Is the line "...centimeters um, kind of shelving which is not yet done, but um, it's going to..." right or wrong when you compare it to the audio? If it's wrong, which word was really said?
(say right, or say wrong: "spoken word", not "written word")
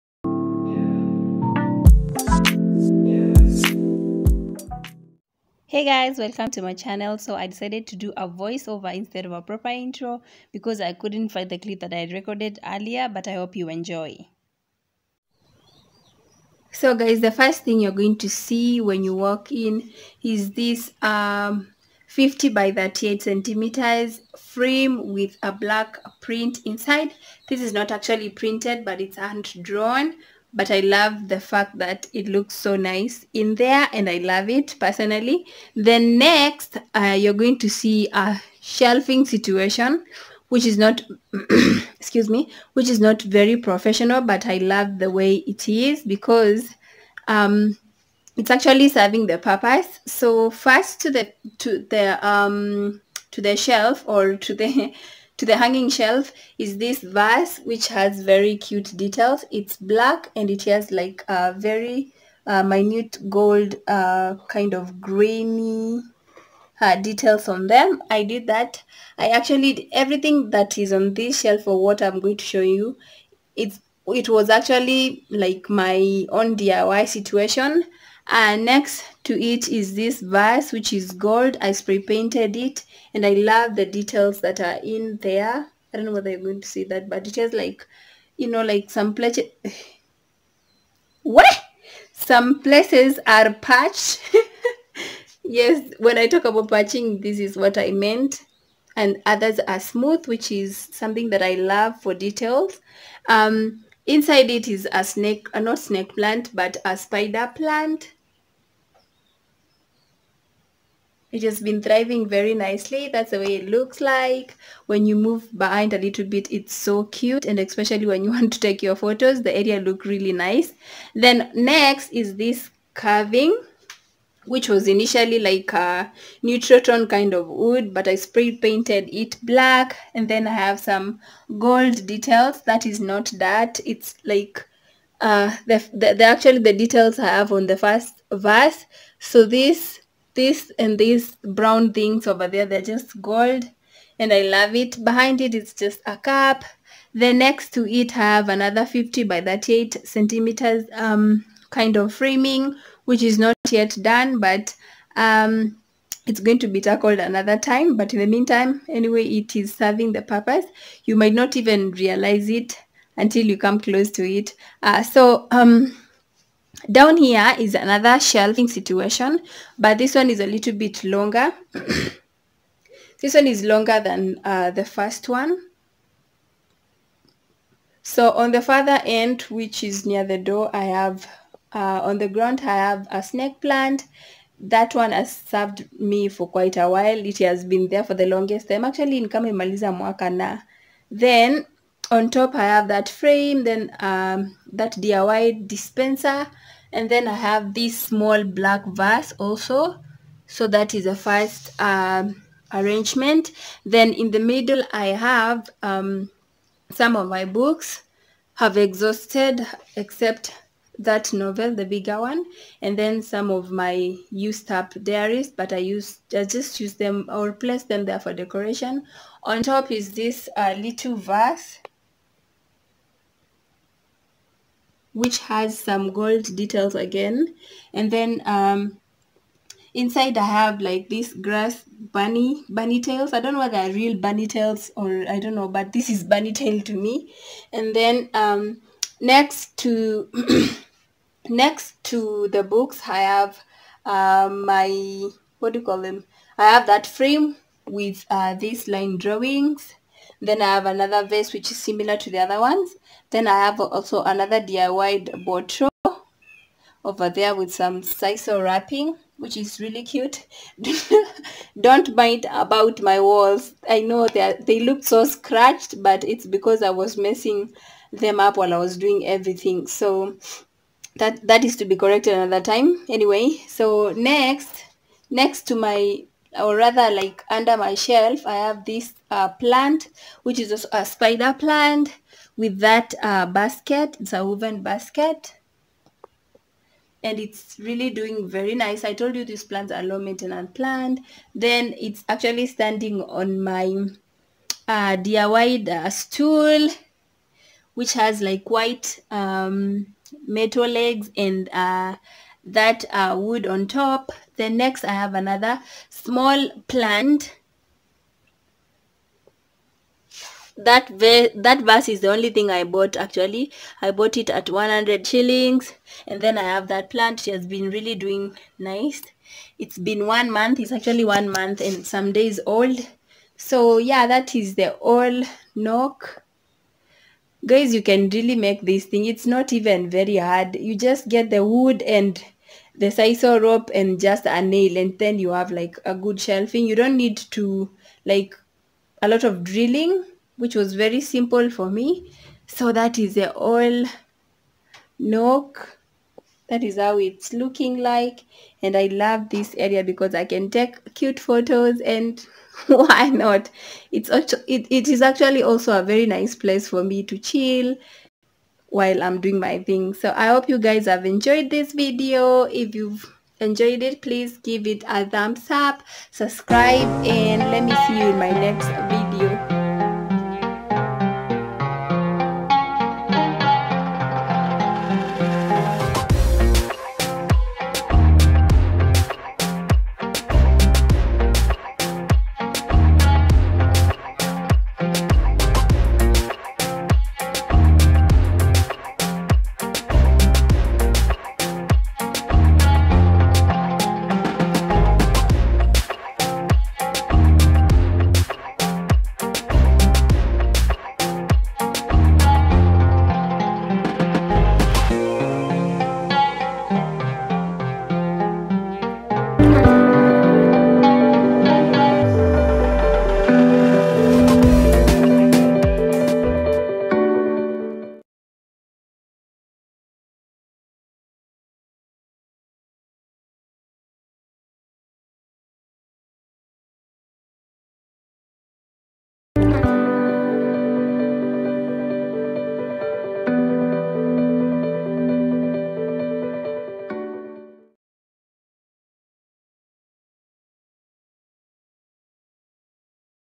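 wrong: "framing", not "shelving".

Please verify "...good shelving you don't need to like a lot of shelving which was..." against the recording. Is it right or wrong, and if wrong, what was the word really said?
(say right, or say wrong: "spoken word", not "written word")
wrong: "drilling", not "shelving".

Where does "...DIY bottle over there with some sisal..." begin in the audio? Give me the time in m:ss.
4:14.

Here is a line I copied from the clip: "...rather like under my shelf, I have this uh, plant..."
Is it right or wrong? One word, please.
right.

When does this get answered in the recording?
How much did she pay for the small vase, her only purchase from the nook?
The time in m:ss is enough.
5:14.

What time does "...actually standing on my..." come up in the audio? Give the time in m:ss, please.
4:52.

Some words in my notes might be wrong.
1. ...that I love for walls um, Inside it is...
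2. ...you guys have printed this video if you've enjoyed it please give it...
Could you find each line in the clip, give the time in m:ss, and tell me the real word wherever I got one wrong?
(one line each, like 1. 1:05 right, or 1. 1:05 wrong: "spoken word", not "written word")
1. 1:41 wrong: "details", not "walls"
2. 6:00 wrong: "enjoyed", not "printed".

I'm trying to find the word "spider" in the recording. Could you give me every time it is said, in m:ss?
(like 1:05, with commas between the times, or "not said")
1:46, 4:41.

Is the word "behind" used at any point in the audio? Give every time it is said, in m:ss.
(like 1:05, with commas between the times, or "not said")
1:55, 2:25.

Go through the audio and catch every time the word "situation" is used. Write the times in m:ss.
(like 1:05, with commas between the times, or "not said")
0:39, 1:17, 2:48.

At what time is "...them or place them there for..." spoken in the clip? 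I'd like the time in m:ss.
3:36.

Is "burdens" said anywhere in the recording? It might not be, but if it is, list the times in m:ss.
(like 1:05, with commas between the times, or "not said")
not said.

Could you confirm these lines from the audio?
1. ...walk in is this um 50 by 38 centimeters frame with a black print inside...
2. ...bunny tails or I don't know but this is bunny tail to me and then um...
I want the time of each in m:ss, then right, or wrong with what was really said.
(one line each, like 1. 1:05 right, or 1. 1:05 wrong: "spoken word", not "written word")
1. 0:19 right
2. 3:54 right.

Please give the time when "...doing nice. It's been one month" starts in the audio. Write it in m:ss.
5:18.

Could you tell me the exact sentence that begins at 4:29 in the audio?
So that that is to be corrected another time.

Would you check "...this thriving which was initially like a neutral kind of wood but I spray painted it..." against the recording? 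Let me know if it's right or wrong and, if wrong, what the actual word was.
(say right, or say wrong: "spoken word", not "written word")
wrong: "carving", not "thriving".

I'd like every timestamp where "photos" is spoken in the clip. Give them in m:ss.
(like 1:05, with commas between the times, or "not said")
1:58, 5:51.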